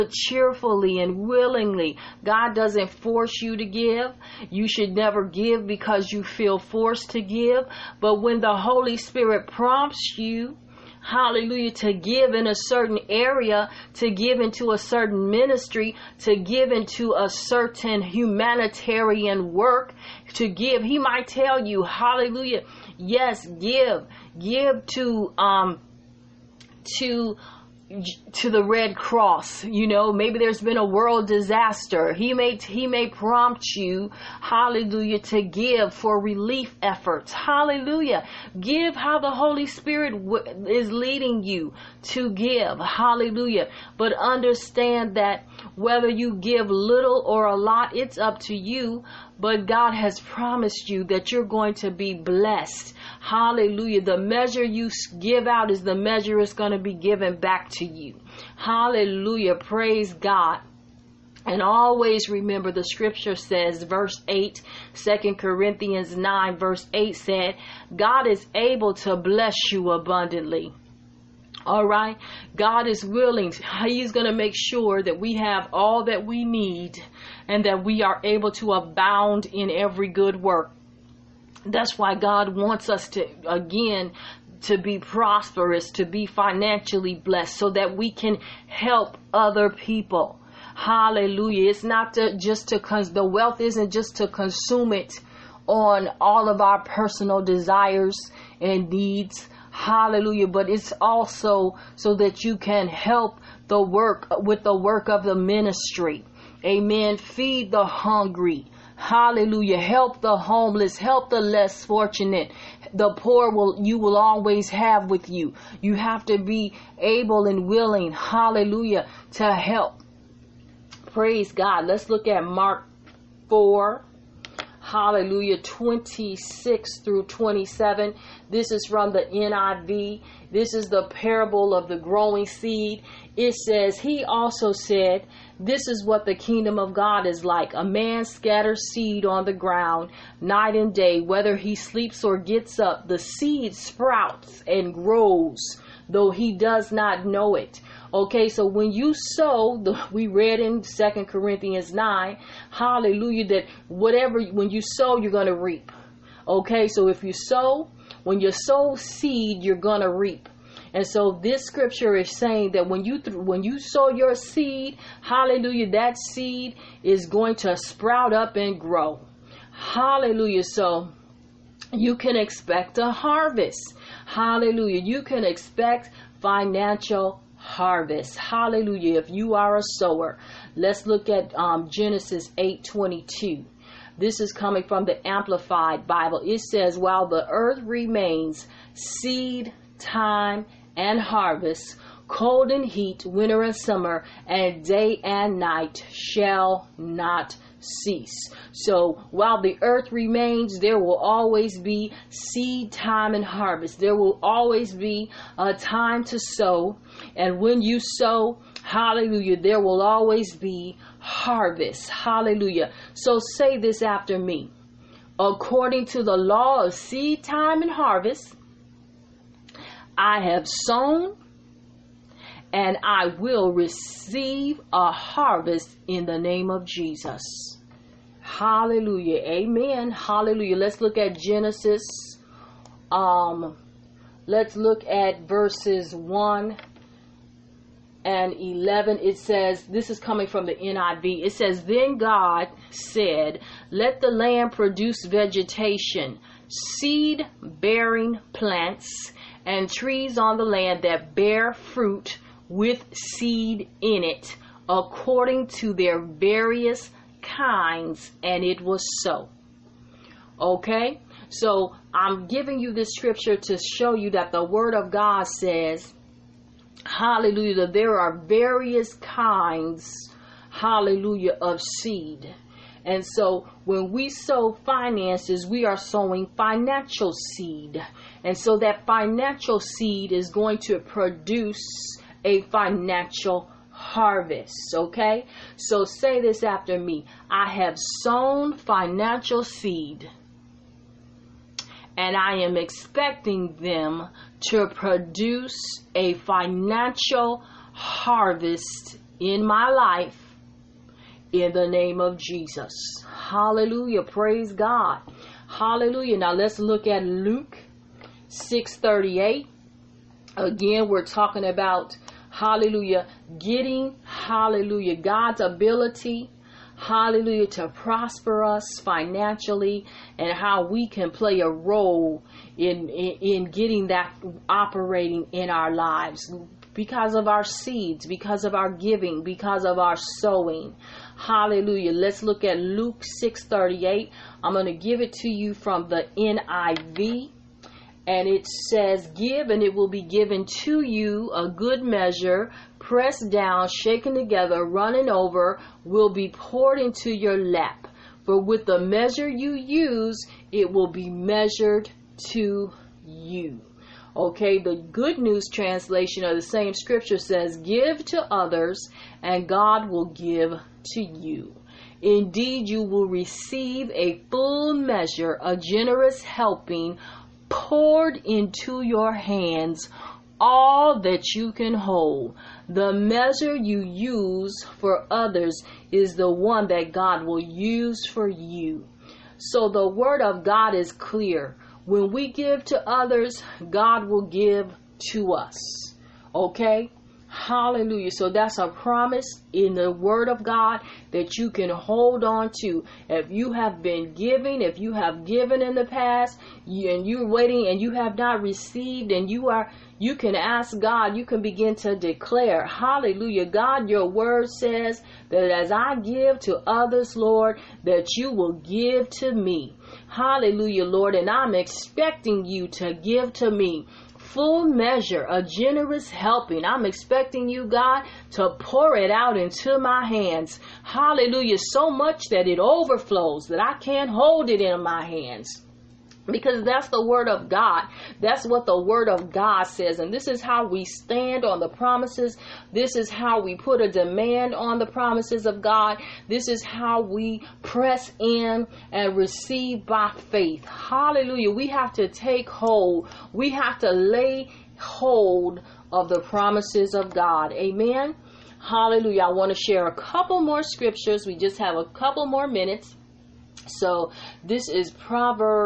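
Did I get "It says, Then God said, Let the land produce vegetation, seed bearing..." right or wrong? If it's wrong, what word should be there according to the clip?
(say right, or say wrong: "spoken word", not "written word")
right.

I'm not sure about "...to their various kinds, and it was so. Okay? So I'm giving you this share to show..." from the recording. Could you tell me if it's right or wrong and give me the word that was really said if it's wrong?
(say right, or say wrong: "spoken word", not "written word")
wrong: "scripture", not "share".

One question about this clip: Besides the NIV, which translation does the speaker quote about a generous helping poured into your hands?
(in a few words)
Good News.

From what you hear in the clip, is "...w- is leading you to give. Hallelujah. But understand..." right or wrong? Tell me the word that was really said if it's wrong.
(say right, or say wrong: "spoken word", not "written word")
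right.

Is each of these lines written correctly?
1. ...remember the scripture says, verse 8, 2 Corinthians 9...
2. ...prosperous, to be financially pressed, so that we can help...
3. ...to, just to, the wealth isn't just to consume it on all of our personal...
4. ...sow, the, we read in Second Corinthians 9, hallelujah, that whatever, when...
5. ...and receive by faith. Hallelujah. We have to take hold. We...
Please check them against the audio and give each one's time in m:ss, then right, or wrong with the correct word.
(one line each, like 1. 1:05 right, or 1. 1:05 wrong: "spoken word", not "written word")
1. 1:02 right
2. 1:24 wrong: "blessed", not "pressed"
3. 1:32 right
4. 2:29 right
5. 7:19 right.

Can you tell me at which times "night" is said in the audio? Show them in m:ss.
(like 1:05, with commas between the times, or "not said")
2:20, 3:15.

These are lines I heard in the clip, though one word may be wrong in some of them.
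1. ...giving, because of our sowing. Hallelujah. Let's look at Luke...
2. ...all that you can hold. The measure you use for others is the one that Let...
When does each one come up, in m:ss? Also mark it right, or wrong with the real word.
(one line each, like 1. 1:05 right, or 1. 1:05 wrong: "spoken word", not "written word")
1. 5:28 right
2. 6:10 wrong: "God", not "Let".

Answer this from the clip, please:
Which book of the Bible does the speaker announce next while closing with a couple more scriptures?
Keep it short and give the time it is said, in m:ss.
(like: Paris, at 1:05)
Proverbs, at 7:35.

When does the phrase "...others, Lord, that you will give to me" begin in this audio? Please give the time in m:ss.
6:46.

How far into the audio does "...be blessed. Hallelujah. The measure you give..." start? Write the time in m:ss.
0:51.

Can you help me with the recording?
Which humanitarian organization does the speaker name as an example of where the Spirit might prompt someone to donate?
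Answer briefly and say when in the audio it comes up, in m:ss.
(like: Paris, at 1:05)
Red Cross, at 0:28.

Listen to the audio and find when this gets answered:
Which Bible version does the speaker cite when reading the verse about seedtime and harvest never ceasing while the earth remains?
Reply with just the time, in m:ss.
3:05.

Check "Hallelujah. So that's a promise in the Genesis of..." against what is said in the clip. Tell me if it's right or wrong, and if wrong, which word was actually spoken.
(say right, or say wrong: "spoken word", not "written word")
wrong: "Word", not "Genesis".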